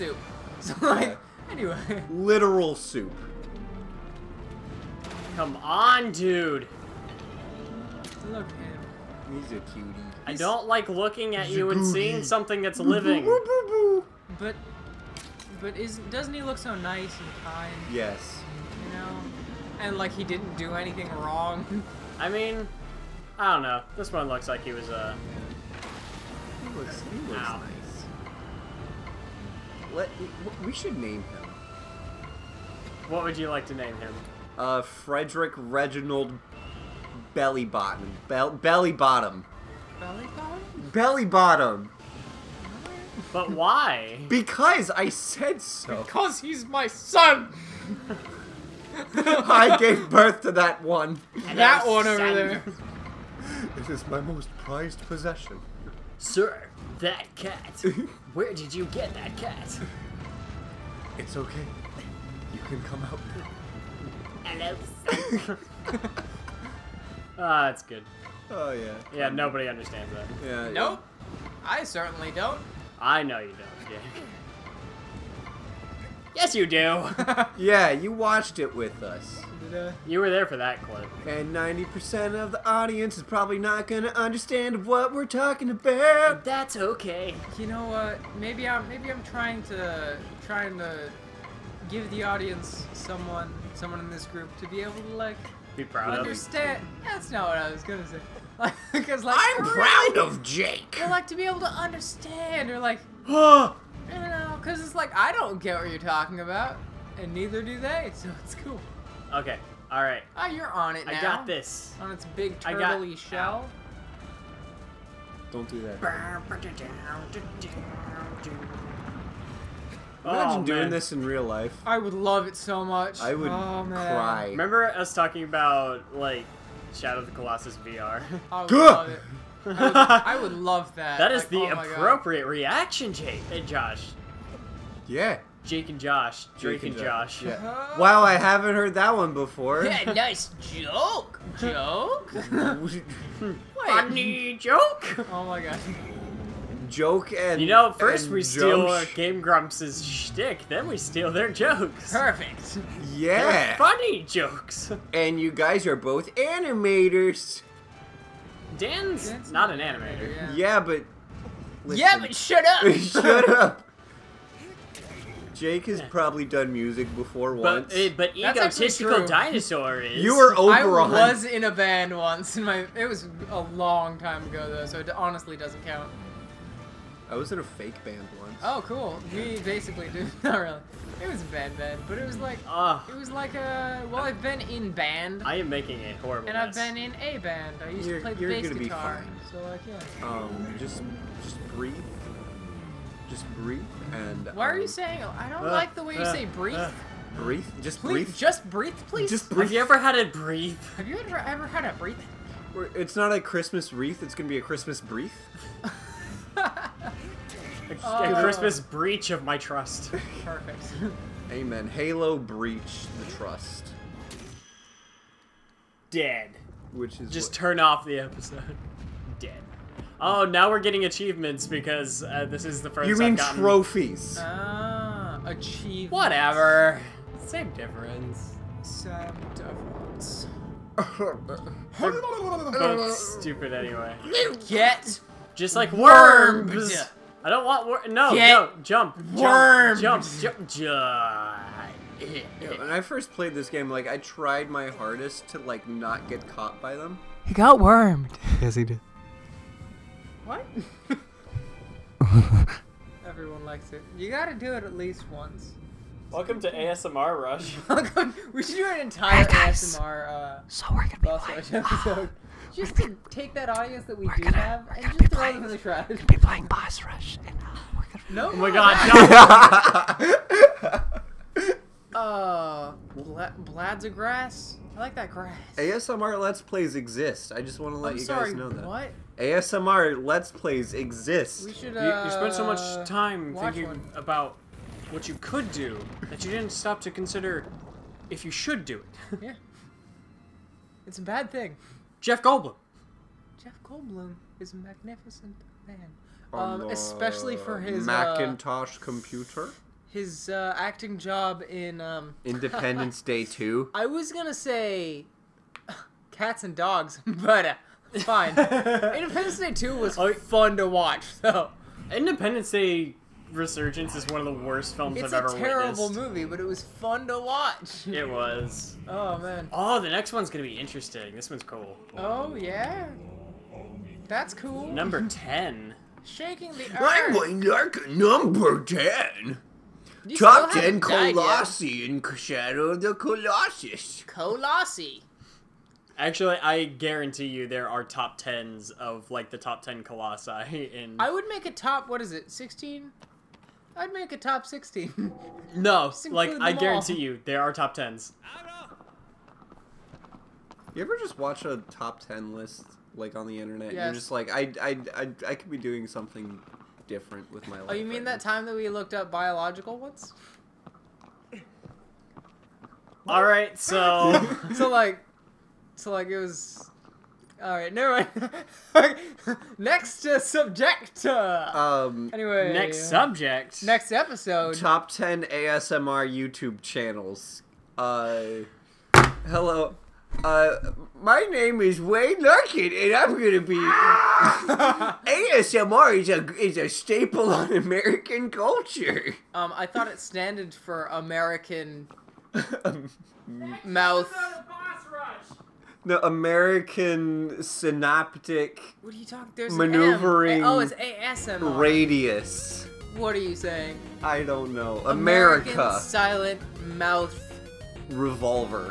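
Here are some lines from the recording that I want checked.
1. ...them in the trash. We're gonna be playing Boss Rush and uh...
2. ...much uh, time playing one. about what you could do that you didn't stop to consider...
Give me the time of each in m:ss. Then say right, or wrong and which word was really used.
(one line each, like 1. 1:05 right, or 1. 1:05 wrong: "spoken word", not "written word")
1. 4:25 right
2. 4:42 wrong: "thinking", not "playing".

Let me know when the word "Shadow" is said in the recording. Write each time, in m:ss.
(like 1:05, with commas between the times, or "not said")
2:06, 5:32.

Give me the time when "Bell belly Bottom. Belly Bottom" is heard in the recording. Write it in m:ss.
0:38.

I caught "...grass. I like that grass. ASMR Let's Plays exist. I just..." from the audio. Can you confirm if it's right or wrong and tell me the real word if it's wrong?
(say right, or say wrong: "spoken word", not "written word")
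right.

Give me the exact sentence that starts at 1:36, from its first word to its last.
Of that's not what I was going to say.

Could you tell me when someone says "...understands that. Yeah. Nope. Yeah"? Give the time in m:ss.
1:09.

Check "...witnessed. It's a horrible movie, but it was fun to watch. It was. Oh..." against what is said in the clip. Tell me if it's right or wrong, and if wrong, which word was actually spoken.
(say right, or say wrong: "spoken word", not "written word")
wrong: "terrible", not "horrible".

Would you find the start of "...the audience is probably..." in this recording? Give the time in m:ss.
1:22.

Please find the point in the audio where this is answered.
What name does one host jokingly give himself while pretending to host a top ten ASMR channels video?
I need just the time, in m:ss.
6:22.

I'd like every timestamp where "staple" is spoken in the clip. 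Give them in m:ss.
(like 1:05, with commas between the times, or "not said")
6:26.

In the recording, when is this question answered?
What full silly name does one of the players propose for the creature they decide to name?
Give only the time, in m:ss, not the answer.
0:34.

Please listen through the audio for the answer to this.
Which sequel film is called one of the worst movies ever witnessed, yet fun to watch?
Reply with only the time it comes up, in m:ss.
5:12.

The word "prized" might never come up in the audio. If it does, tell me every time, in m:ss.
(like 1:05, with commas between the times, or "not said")
0:54.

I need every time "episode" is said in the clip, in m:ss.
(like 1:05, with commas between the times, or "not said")
3:38, 4:21, 6:14.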